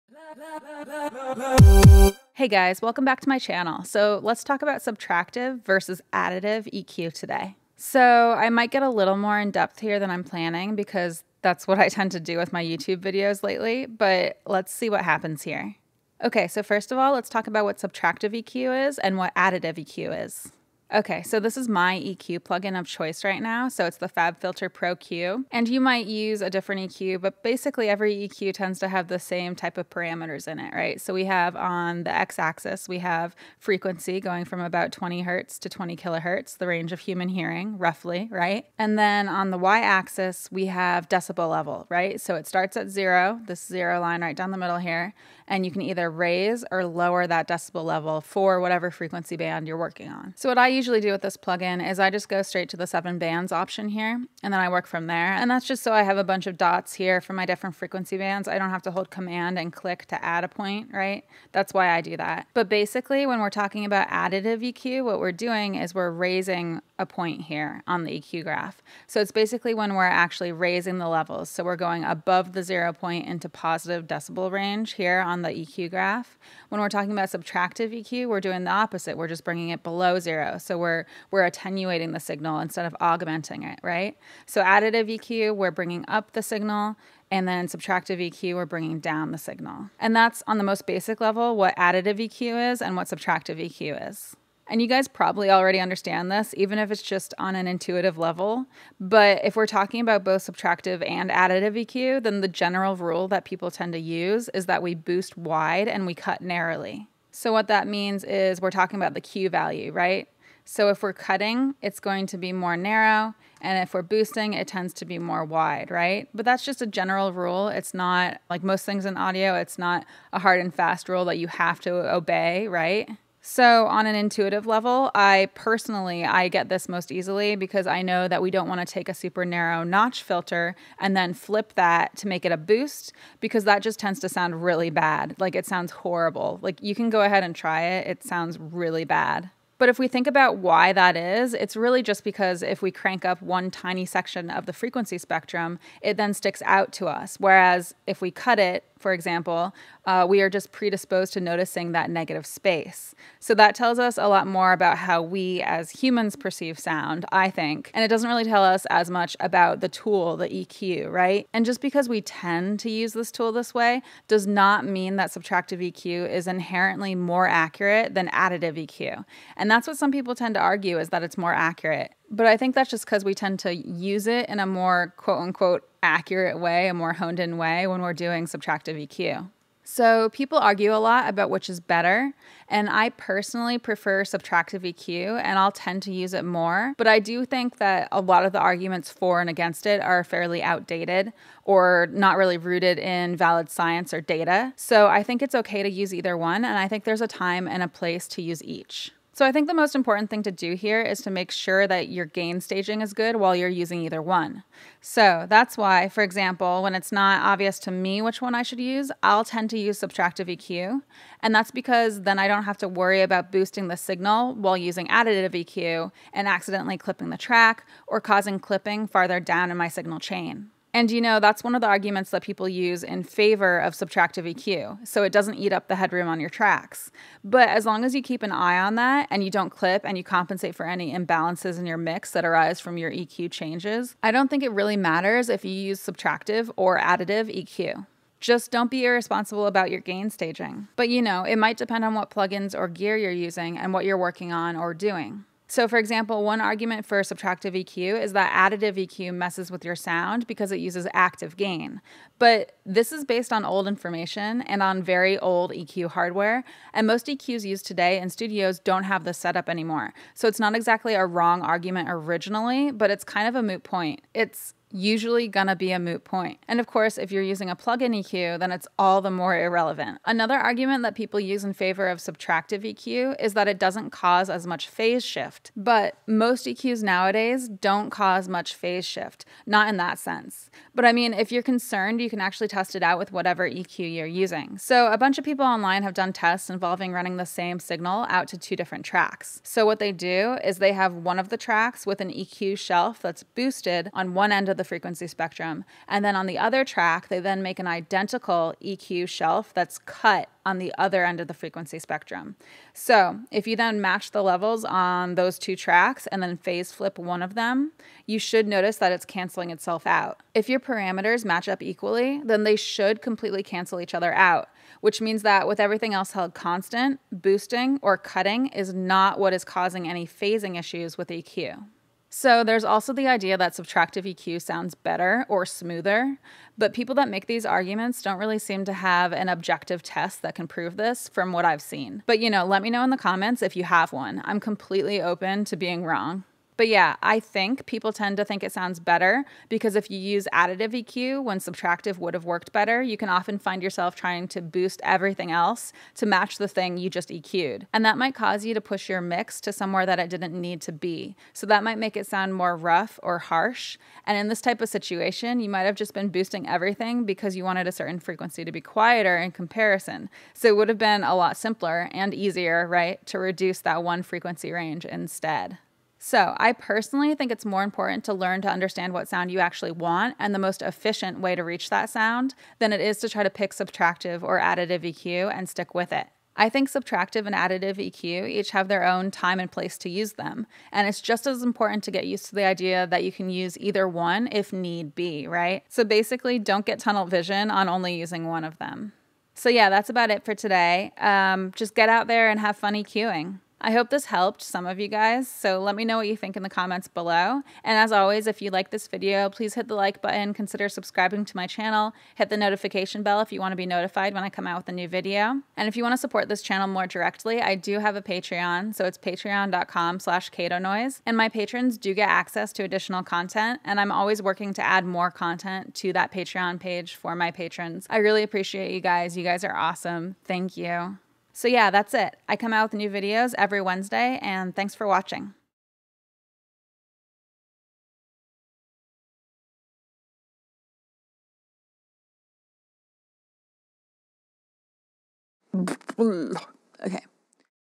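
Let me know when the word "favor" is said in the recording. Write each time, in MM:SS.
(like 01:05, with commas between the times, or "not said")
03:43, 04:31.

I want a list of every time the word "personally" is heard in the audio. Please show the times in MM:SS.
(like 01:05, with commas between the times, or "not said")
02:05, 03:03, 06:06.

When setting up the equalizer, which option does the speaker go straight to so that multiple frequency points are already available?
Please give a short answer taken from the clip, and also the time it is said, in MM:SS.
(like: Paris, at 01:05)
seven bands, at 00:52.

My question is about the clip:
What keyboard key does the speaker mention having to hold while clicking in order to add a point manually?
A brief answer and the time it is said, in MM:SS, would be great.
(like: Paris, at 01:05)
command, at 00:59.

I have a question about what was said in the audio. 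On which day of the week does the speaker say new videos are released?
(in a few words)
Wednesday.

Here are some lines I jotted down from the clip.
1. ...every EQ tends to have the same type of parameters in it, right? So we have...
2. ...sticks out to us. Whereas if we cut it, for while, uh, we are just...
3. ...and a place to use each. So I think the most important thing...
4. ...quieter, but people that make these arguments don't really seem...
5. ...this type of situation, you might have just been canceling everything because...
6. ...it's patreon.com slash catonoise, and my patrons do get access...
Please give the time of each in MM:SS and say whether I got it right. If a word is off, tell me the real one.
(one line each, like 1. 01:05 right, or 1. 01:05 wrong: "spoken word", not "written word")
1. 00:27 right
2. 02:26 wrong: "example", not "while"
3. 03:17 right
4. 05:25 wrong: "smoother", not "quieter"
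5. 05:54 wrong: "boosting", not "canceling"
6. 06:49 right.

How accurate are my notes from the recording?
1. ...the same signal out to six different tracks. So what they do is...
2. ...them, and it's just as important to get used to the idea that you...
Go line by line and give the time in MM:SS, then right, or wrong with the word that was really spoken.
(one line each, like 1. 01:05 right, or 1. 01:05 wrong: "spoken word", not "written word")
1. 04:47 wrong: "two", not "six"
2. 06:20 right.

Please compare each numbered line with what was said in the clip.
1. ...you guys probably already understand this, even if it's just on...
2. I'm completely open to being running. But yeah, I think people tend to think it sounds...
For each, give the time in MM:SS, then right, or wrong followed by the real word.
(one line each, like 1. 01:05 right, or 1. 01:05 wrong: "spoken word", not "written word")
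1. 01:34 right
2. 05:34 wrong: "wrong", not "running".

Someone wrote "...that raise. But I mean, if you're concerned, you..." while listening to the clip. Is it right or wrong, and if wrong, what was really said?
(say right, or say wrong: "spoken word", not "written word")
wrong: "sense", not "raise".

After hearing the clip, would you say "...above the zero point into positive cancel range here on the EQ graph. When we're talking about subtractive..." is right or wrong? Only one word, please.
wrong.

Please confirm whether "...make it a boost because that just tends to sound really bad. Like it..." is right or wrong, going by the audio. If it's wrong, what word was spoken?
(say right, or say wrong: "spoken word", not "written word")
right.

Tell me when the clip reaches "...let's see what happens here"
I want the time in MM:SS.
00:14.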